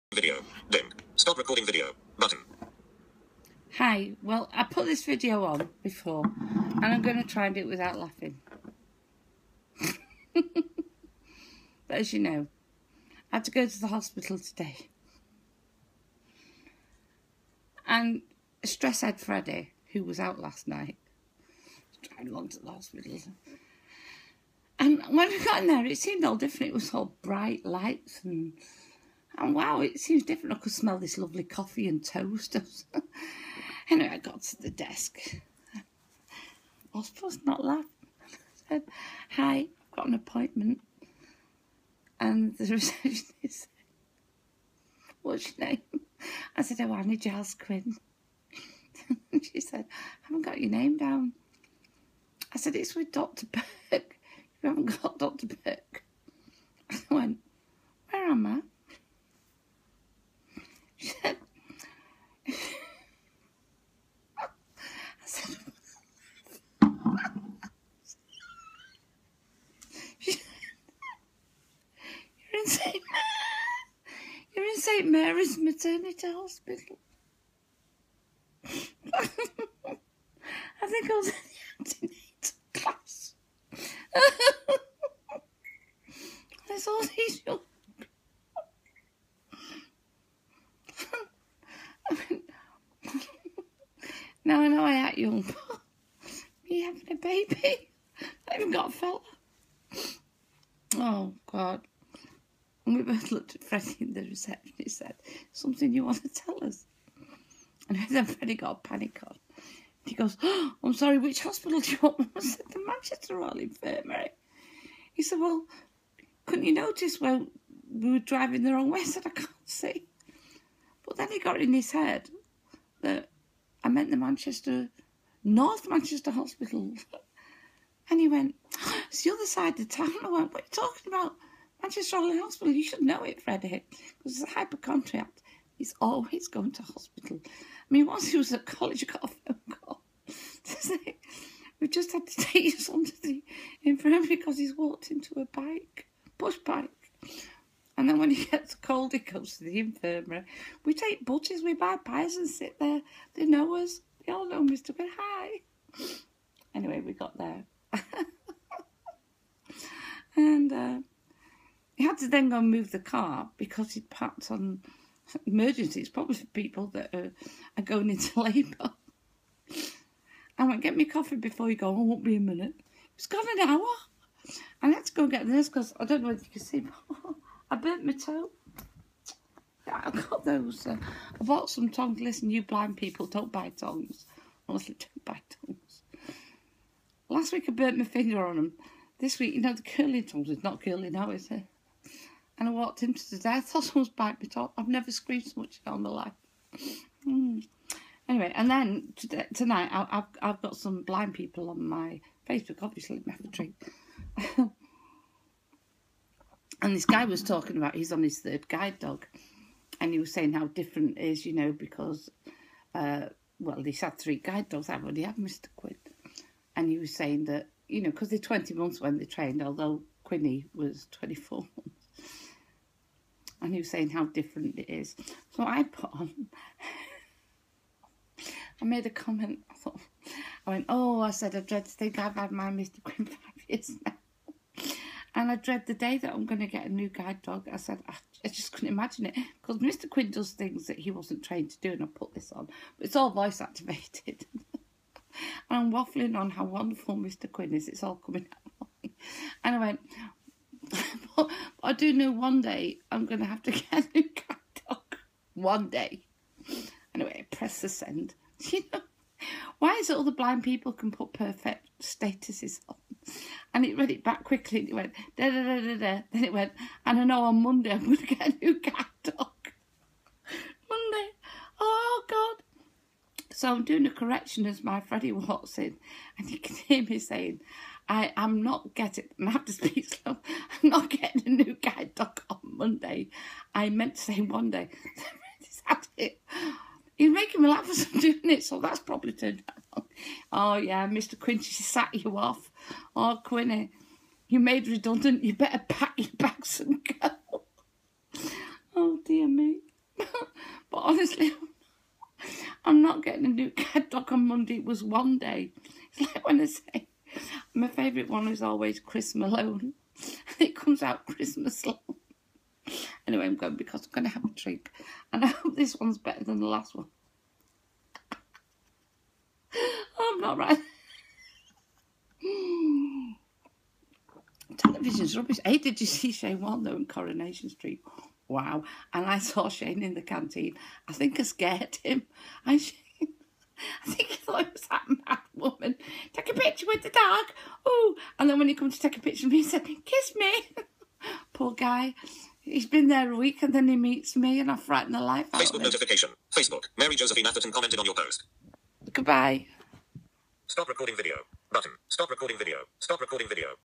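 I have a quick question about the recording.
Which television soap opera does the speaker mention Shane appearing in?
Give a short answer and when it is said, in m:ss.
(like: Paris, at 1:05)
Coronation Street, at 5:27.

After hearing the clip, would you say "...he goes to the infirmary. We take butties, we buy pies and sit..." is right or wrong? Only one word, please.
right.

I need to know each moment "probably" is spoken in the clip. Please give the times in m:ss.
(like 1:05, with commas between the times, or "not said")
2:46, 4:48.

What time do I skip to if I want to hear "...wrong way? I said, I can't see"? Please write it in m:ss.
1:58.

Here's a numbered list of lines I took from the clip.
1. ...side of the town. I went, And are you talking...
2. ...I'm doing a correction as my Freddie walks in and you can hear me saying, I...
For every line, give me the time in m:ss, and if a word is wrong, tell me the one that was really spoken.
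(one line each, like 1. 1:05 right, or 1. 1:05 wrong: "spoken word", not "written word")
1. 2:09 wrong: "What", not "And"
2. 4:33 right.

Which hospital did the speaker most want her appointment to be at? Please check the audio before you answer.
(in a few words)
Manchester Royal Infirmary.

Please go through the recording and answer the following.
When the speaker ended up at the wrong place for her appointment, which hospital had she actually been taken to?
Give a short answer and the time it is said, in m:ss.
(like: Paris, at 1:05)
St. Mary's Maternity Hospital, at 1:14.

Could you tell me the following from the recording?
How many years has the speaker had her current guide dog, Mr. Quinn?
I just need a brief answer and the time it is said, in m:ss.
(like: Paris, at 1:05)
5, at 3:53.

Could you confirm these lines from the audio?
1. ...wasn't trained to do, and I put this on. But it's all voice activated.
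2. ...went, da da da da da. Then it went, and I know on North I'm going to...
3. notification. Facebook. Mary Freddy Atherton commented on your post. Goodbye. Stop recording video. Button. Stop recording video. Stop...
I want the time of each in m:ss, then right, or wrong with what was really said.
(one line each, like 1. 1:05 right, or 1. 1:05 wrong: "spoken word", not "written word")
1. 4:01 right
2. 4:24 wrong: "Monday", not "North"
3. 5:45 wrong: "Josephine", not "Freddy".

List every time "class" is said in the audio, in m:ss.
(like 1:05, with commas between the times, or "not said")
1:22.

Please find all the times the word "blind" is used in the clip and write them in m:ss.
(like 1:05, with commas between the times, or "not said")
3:02, 3:21, 4:20.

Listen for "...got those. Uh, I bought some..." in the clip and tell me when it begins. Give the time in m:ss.
3:00.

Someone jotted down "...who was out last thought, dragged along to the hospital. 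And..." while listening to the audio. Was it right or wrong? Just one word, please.
wrong.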